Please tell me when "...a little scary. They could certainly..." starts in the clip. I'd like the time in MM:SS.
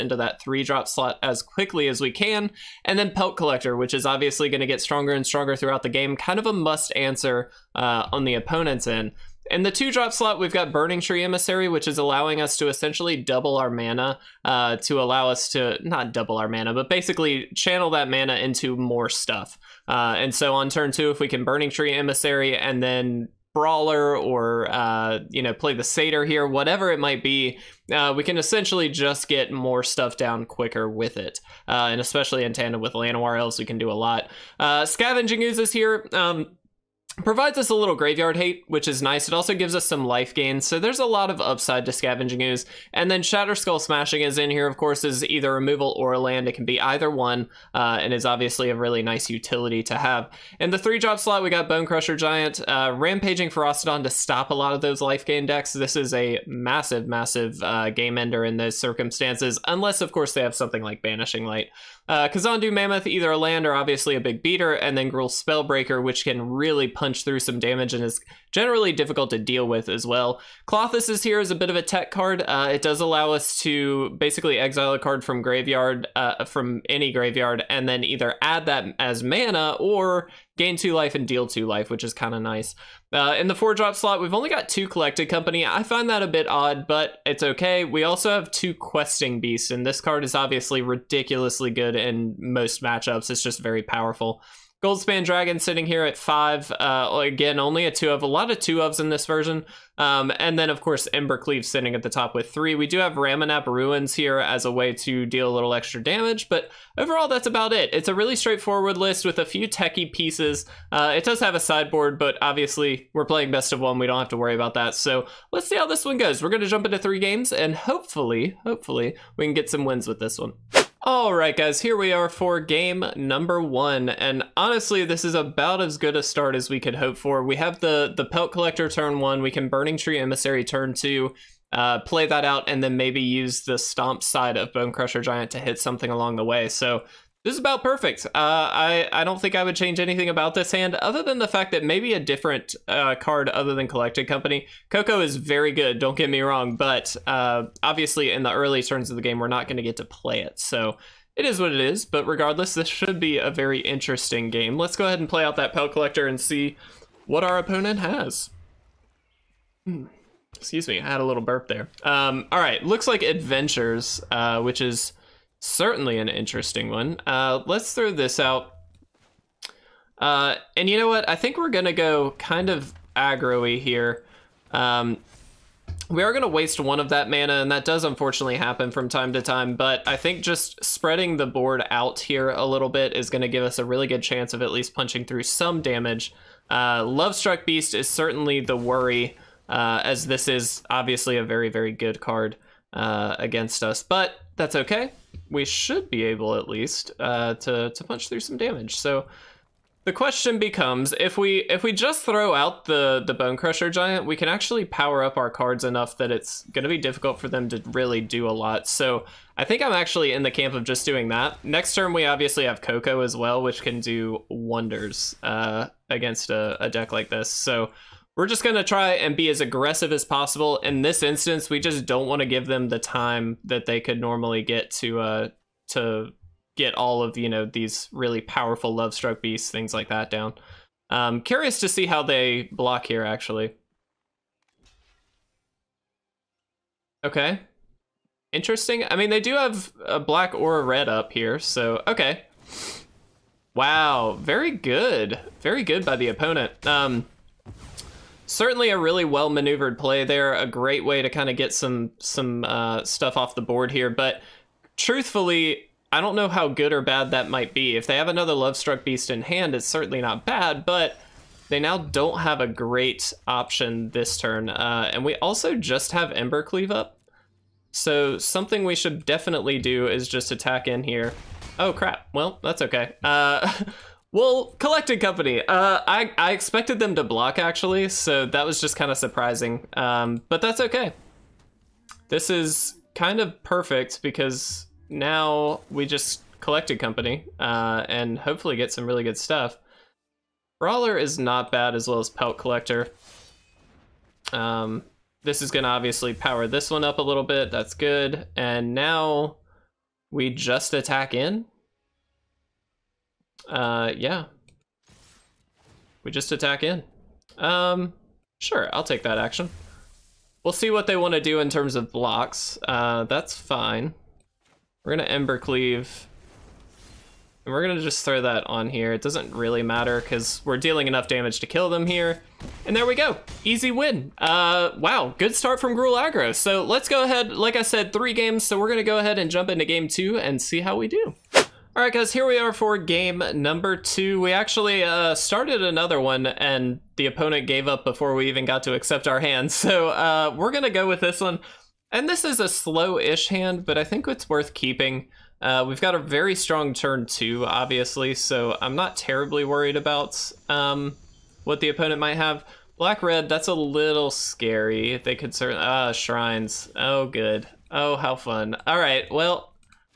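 05:53.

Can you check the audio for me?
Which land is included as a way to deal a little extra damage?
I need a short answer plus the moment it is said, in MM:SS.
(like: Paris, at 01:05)
Ramunap Ruins, at 01:43.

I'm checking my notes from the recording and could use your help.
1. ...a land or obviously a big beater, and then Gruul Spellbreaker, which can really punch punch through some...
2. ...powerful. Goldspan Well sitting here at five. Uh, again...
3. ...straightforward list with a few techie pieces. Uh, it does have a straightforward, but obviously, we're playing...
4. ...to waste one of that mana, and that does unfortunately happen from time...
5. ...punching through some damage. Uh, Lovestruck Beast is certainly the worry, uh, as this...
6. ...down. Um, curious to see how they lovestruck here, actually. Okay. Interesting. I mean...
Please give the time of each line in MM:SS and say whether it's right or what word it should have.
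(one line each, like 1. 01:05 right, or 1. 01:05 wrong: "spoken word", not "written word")
1. 01:03 right
2. 01:33 wrong: "Dragon", not "Well"
3. 01:48 wrong: "sideboard", not "straightforward"
4. 02:56 right
5. 03:04 right
6. 03:50 wrong: "block", not "lovestruck".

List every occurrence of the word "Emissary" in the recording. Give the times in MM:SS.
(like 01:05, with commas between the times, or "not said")
00:11, 00:21, 02:10.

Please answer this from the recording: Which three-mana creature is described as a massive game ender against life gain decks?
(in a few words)
Rampaging Ferocidon.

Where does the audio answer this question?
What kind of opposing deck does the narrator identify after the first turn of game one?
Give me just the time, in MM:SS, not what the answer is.
02:43.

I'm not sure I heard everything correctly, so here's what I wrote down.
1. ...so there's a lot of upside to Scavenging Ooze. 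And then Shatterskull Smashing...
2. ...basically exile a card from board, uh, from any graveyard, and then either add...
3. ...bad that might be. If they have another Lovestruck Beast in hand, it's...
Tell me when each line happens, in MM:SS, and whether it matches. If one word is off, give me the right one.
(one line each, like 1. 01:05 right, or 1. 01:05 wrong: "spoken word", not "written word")
1. 00:40 right
2. 01:14 wrong: "graveyard", not "board"
3. 04:17 right.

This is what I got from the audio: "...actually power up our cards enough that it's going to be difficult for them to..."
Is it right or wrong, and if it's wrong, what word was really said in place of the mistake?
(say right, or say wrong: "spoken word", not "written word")
right.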